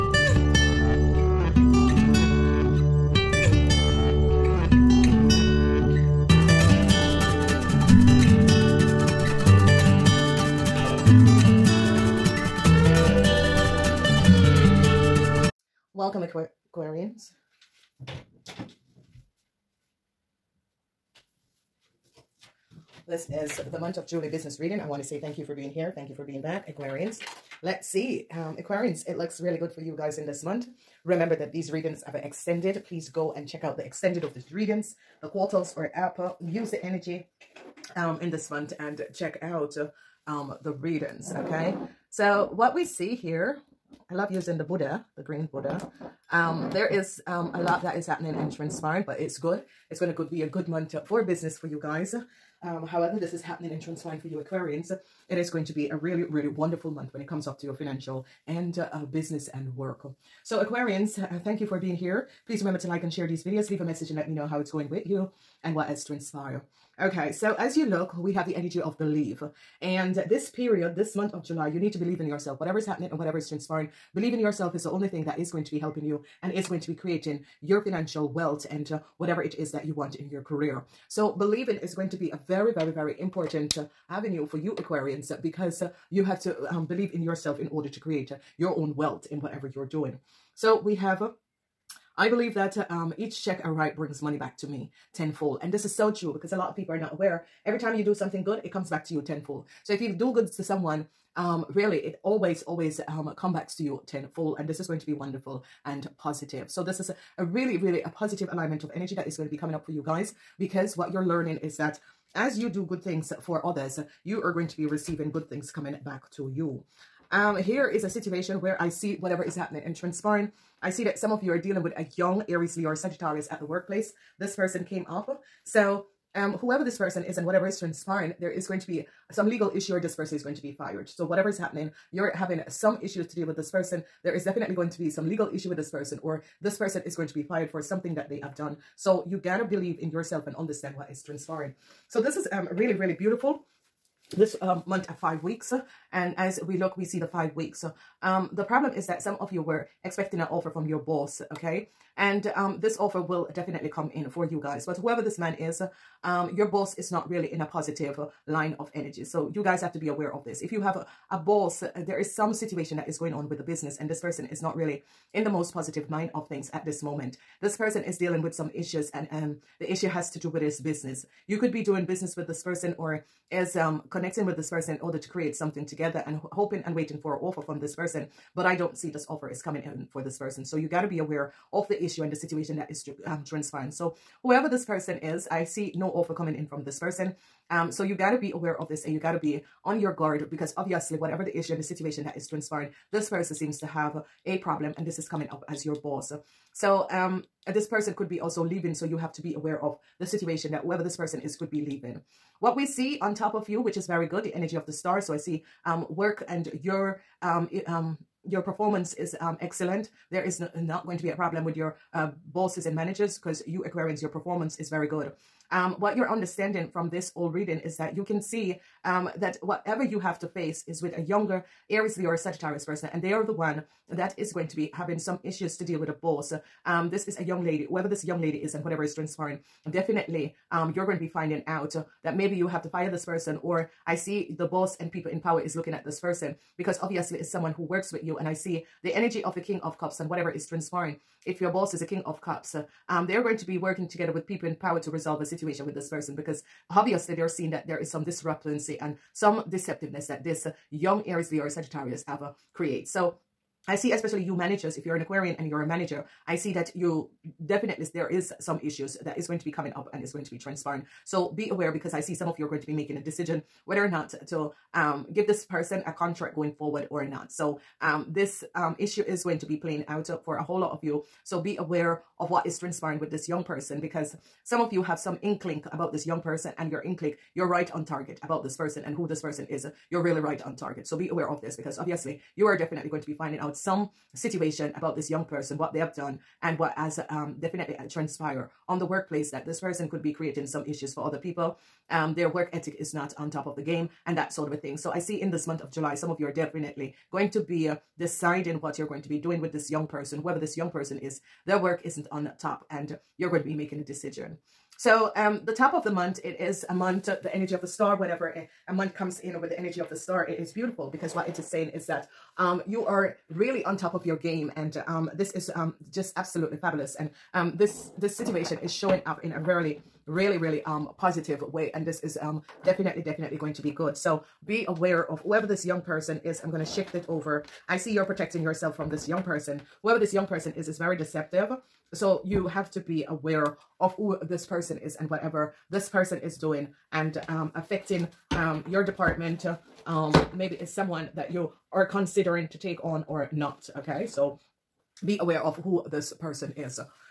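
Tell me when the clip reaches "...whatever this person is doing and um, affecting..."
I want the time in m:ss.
5:35.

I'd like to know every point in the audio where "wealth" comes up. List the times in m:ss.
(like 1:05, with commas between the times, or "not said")
1:18, 1:28.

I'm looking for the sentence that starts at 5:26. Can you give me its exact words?
I'm going to shift it over.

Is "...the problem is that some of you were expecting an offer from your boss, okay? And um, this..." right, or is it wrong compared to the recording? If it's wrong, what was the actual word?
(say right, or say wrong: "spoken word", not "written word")
right.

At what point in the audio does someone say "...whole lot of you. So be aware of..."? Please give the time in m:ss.
4:30.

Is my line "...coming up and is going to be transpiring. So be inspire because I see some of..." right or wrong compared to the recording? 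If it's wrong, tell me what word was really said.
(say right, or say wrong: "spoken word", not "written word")
wrong: "aware", not "inspire".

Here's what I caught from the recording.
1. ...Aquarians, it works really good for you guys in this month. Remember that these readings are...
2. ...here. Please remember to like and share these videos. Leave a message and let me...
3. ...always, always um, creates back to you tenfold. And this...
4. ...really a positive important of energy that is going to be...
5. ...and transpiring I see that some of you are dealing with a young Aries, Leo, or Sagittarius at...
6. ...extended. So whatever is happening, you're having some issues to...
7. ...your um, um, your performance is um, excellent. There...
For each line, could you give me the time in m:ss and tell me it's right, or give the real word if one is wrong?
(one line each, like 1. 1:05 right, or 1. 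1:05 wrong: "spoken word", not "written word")
1. 0:28 wrong: "looks", not "works"
2. 1:01 right
3. 1:42 wrong: "comes", not "creates"
4. 1:47 wrong: "alignment", not "important"
5. 1:59 right
6. 2:10 wrong: "fired", not "extended"
7. 3:26 right.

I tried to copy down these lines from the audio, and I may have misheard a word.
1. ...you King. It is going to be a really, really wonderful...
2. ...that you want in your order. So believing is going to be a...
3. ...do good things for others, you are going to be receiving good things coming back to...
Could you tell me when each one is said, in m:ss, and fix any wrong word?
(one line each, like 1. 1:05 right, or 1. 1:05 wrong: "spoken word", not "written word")
1. 0:54 wrong: "Aquarians", not "King"
2. 1:19 wrong: "career", not "order"
3. 1:52 right.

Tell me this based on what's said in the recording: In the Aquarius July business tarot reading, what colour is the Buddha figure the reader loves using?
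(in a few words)
green.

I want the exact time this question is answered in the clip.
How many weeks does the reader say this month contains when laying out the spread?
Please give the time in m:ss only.
2:24.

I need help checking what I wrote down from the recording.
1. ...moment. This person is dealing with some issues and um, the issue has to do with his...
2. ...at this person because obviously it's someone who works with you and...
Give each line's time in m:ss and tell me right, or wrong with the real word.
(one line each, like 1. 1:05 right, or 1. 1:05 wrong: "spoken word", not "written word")
1. 2:47 right
2. 3:55 right.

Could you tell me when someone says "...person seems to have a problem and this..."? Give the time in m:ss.
3:13.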